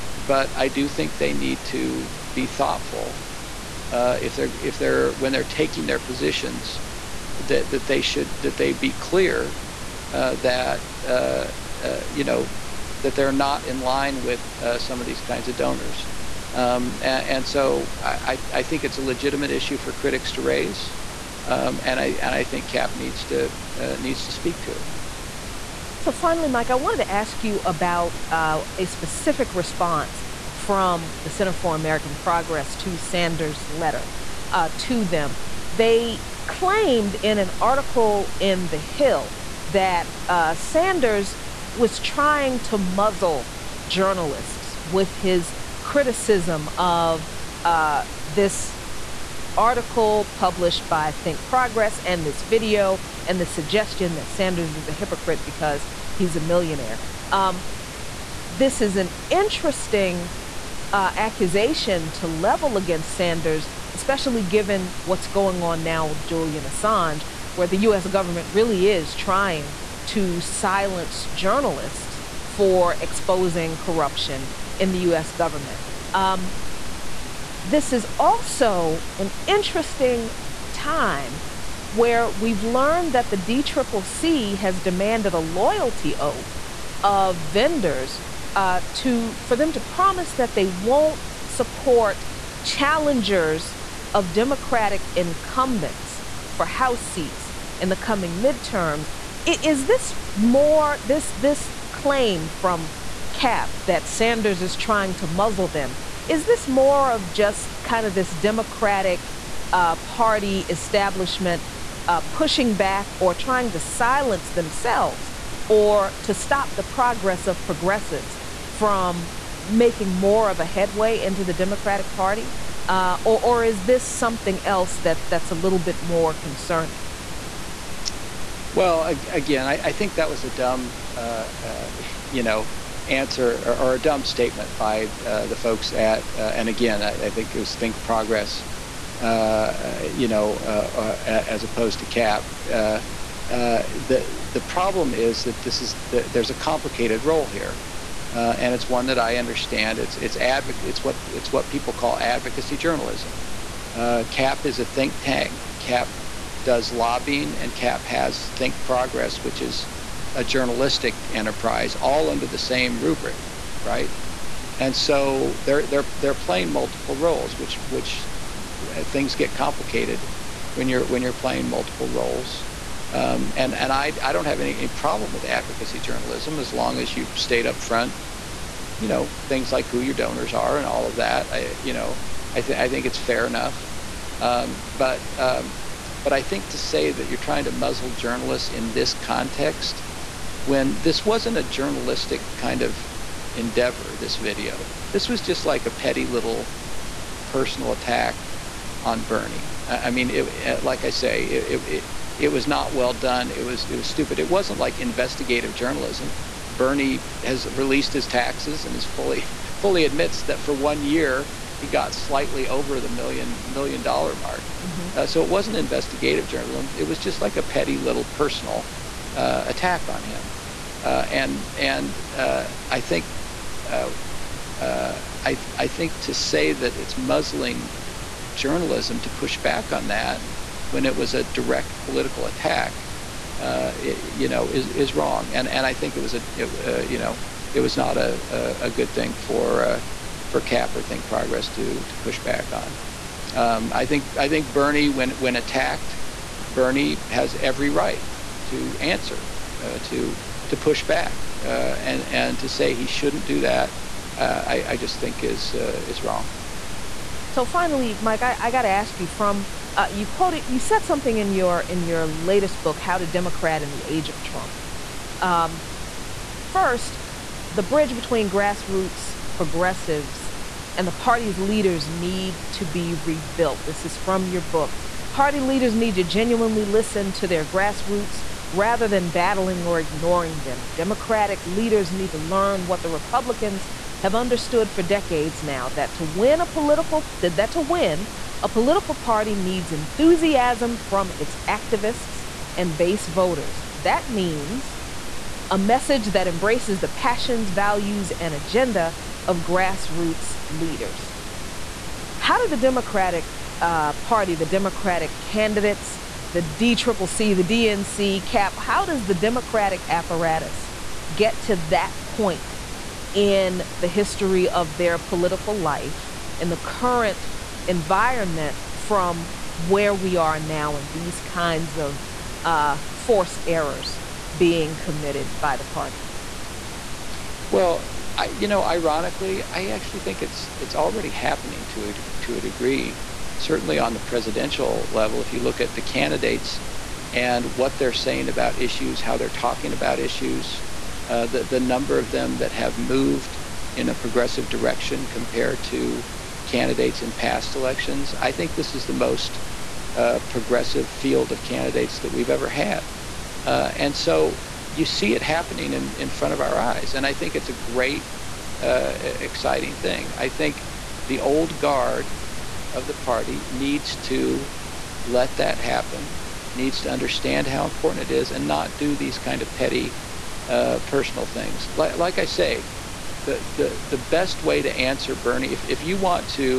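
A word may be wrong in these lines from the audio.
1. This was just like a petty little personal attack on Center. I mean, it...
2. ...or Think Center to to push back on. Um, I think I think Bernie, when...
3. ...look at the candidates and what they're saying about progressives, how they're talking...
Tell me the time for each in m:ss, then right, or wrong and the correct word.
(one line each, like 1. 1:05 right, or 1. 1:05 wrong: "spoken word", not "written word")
1. 3:15 wrong: "Bernie", not "Center"
2. 4:00 wrong: "Progress", not "Center"
3. 5:35 wrong: "issues", not "progressives".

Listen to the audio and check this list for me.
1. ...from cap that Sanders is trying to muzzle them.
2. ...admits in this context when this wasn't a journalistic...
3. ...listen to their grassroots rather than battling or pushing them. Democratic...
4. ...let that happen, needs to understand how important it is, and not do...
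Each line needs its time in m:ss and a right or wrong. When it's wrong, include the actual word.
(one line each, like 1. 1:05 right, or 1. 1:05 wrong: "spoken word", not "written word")
1. 1:42 right
2. 3:08 wrong: "journalists", not "admits"
3. 4:36 wrong: "ignoring", not "pushing"
4. 6:05 right.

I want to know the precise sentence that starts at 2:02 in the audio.
Uh, or, or is this something else that, that's a little bit more concerning?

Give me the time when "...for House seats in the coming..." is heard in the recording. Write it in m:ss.
1:36.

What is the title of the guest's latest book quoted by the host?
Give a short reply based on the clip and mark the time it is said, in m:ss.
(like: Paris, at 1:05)
How to Democrat in the Age of Trump, at 4:22.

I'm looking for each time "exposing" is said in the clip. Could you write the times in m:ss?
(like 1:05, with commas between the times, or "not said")
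1:12.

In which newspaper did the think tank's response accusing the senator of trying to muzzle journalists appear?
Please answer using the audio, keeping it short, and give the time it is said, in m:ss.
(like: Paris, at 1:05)
The Hill, at 0:38.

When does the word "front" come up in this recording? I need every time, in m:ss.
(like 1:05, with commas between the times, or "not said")
2:57, 5:56.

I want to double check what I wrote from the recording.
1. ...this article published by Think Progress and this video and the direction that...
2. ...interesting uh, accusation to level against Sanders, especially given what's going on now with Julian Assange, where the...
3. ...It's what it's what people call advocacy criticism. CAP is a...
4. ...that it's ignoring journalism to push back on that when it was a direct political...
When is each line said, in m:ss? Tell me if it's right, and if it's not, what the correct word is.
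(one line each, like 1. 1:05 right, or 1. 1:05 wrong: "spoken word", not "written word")
1. 0:48 wrong: "suggestion", not "direction"
2. 0:59 right
3. 2:30 wrong: "journalism", not "criticism"
4. 3:46 wrong: "muzzling", not "ignoring".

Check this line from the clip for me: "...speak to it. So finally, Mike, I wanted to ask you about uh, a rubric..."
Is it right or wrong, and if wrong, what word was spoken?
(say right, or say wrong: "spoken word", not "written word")
wrong: "specific", not "rubric".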